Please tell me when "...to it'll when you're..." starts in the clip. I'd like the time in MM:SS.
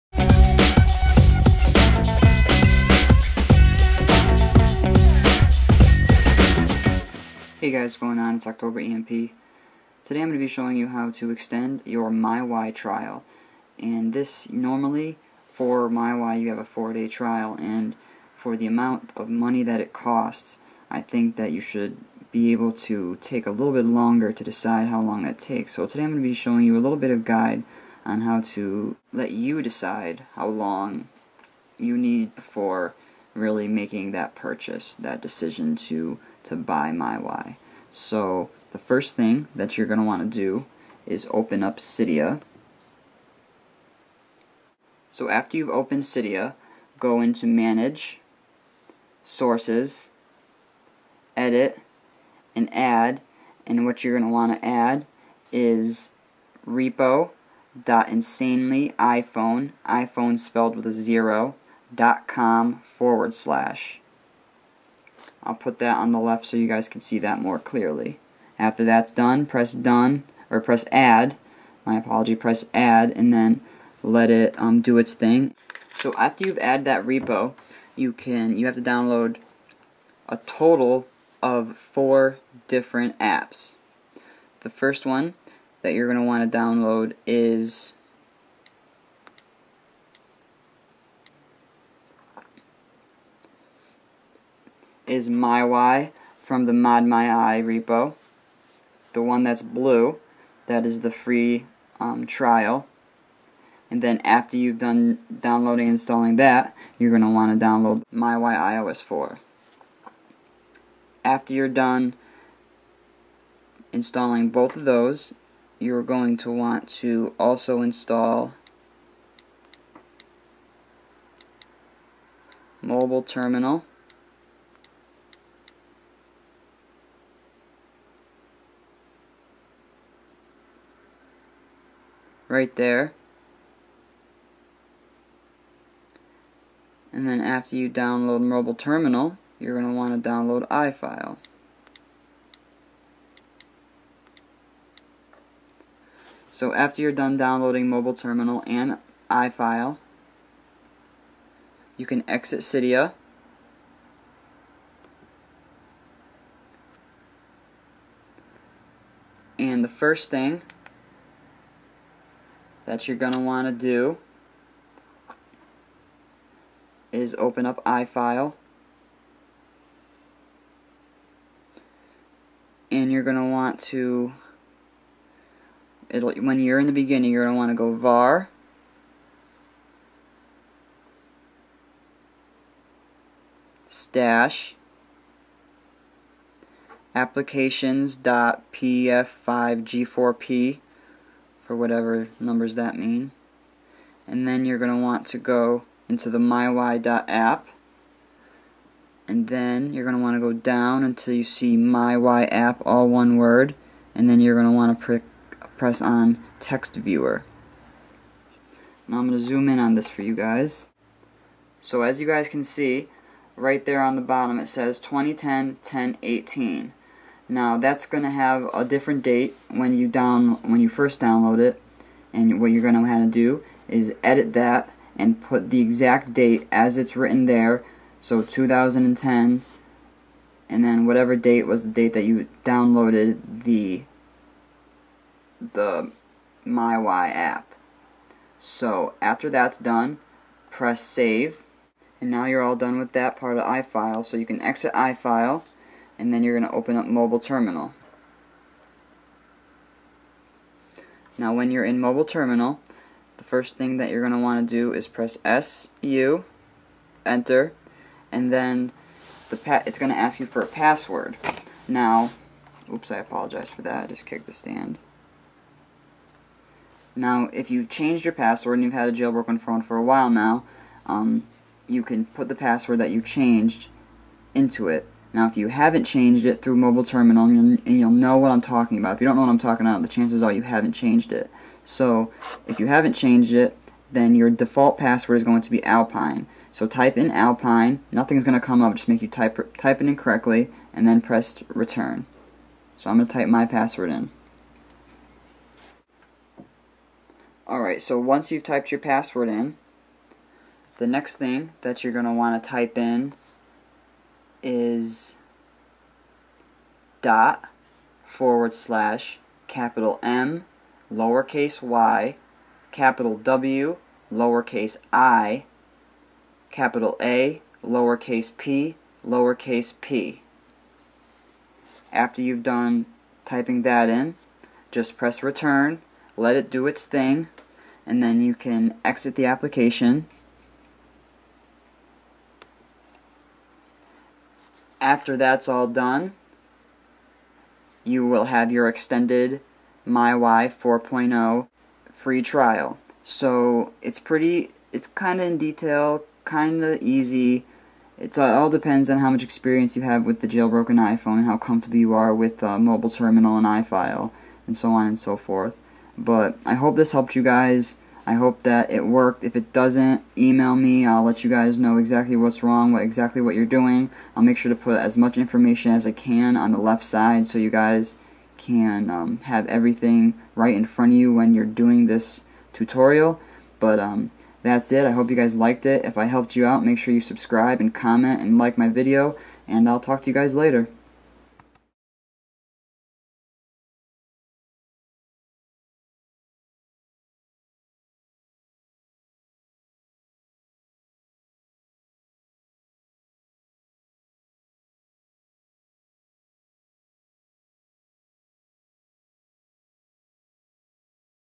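02:53.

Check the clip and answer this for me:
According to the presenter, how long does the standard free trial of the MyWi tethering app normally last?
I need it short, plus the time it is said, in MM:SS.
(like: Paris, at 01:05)
4 days, at 00:16.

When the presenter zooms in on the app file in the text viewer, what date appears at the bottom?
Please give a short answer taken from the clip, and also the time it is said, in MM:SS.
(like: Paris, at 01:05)
2010 1018, at 03:34.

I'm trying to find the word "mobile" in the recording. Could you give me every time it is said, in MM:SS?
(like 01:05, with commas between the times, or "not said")
02:02, 02:18, 02:27, 04:07, 04:11, 04:36, 05:52.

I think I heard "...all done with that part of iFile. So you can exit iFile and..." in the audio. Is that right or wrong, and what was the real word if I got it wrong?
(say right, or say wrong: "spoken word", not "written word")
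right.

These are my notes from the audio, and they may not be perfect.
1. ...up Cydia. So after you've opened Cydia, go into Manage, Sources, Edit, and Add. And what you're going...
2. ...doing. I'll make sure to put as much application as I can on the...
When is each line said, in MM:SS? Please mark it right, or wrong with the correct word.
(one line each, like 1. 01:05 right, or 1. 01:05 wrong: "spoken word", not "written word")
1. 00:41 right
2. 06:03 wrong: "information", not "application".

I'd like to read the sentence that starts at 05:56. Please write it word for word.
But I hope this helped you guys.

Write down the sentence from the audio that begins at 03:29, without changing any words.
Now I'm going to zoom in on this for you guys.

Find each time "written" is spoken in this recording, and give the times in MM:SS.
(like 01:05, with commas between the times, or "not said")
03:47.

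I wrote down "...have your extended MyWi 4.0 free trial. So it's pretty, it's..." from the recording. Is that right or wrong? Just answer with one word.
right.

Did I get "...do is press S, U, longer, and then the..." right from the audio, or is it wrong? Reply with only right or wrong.
wrong.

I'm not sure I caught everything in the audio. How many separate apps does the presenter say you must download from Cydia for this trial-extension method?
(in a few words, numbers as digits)
4.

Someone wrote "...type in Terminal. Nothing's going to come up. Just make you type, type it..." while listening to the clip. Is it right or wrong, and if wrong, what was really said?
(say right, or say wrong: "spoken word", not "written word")
wrong: "Alpine", not "Terminal".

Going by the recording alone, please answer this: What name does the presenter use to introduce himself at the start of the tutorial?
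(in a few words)
October EMP.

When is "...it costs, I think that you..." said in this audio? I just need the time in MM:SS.
00:19.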